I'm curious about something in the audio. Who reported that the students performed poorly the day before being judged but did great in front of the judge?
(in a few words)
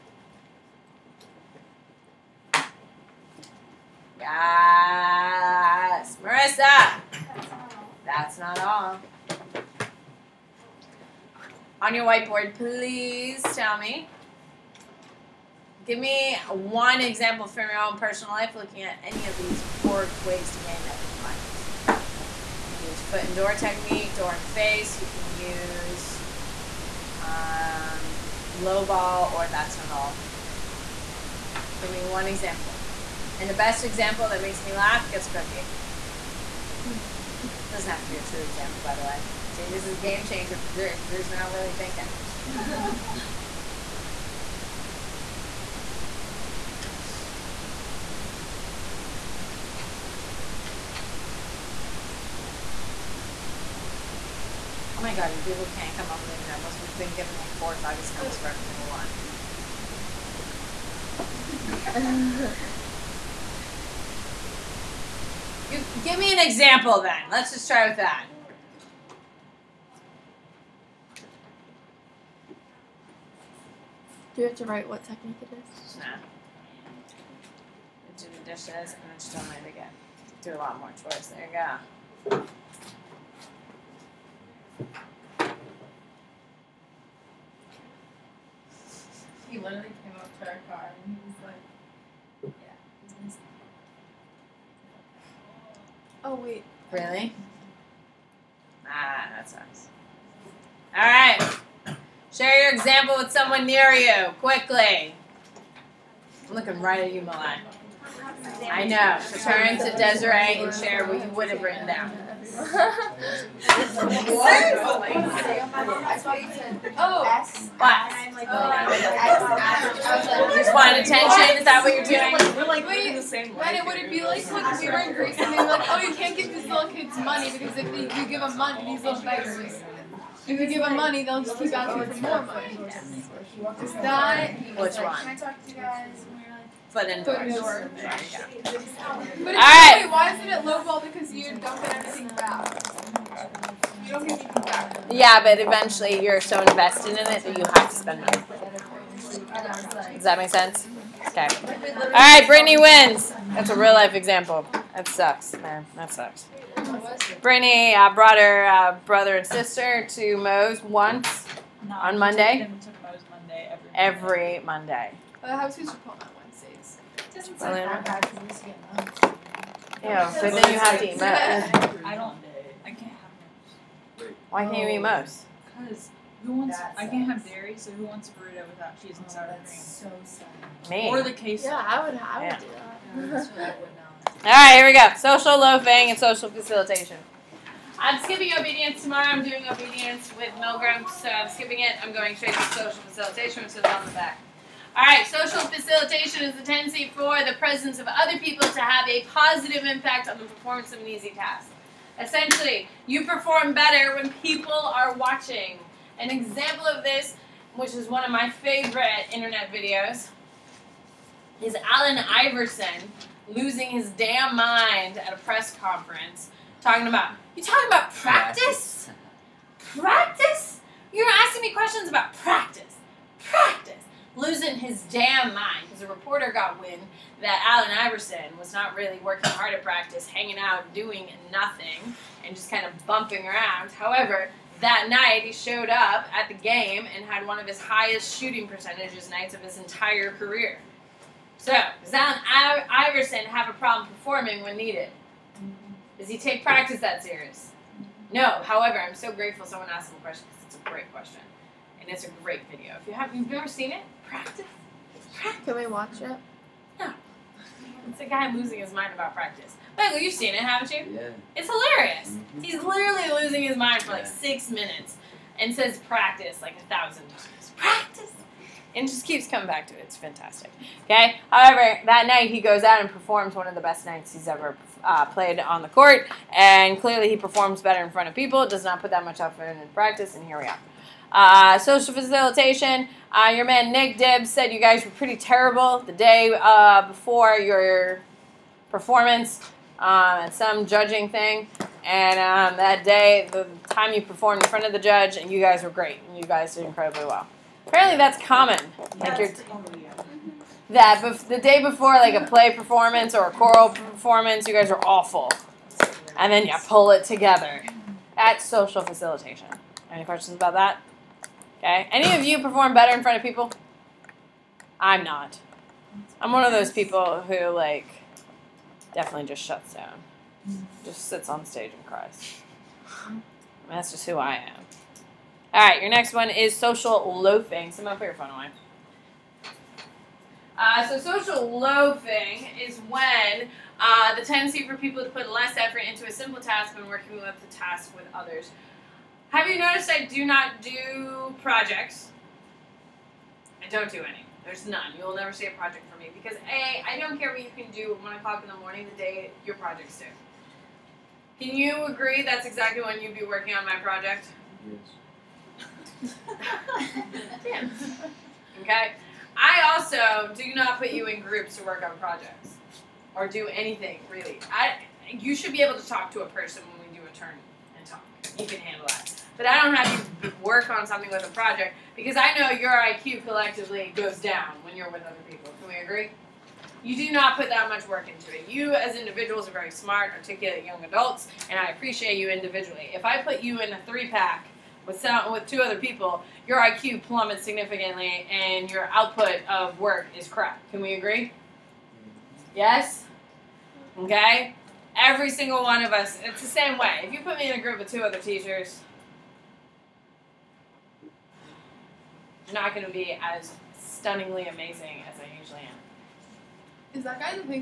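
Nick Dibbs.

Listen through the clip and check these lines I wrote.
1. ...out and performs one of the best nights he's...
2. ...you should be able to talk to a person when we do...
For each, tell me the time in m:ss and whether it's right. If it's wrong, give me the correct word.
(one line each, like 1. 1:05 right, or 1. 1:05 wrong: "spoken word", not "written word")
1. 4:32 right
2. 6:05 right.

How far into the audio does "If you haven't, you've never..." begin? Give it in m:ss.
4:12.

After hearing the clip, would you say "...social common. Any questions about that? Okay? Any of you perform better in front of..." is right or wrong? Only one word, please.
wrong.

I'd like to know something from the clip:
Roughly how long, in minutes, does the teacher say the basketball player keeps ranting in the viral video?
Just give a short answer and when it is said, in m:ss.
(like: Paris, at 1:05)
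6 minutes, at 4:24.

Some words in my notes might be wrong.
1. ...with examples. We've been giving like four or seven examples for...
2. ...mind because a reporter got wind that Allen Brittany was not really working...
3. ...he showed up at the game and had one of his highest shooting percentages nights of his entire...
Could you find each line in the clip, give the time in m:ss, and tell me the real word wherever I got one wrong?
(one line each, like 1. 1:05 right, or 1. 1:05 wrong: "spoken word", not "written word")
1. 0:56 wrong: "five", not "seven"
2. 3:45 wrong: "Iverson", not "Brittany"
3. 3:55 right.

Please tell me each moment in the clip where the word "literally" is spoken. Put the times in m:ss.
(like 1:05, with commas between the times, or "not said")
1:29, 4:22.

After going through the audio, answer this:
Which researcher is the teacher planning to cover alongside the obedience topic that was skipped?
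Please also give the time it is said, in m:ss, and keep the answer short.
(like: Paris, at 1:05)
Milgram, at 3:10.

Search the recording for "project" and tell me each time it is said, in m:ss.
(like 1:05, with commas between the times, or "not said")
5:41, 5:45, 5:49, 5:53, 6:02, 6:11.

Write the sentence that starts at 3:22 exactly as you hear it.
Essentially, you perform better when people are watching.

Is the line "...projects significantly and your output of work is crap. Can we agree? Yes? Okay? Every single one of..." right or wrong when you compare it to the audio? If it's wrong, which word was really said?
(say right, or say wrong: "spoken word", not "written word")
wrong: "plummets", not "projects".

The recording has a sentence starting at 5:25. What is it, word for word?
All right, your next one is social loafing.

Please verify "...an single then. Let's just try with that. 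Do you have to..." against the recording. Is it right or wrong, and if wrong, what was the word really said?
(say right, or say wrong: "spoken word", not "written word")
wrong: "example", not "single".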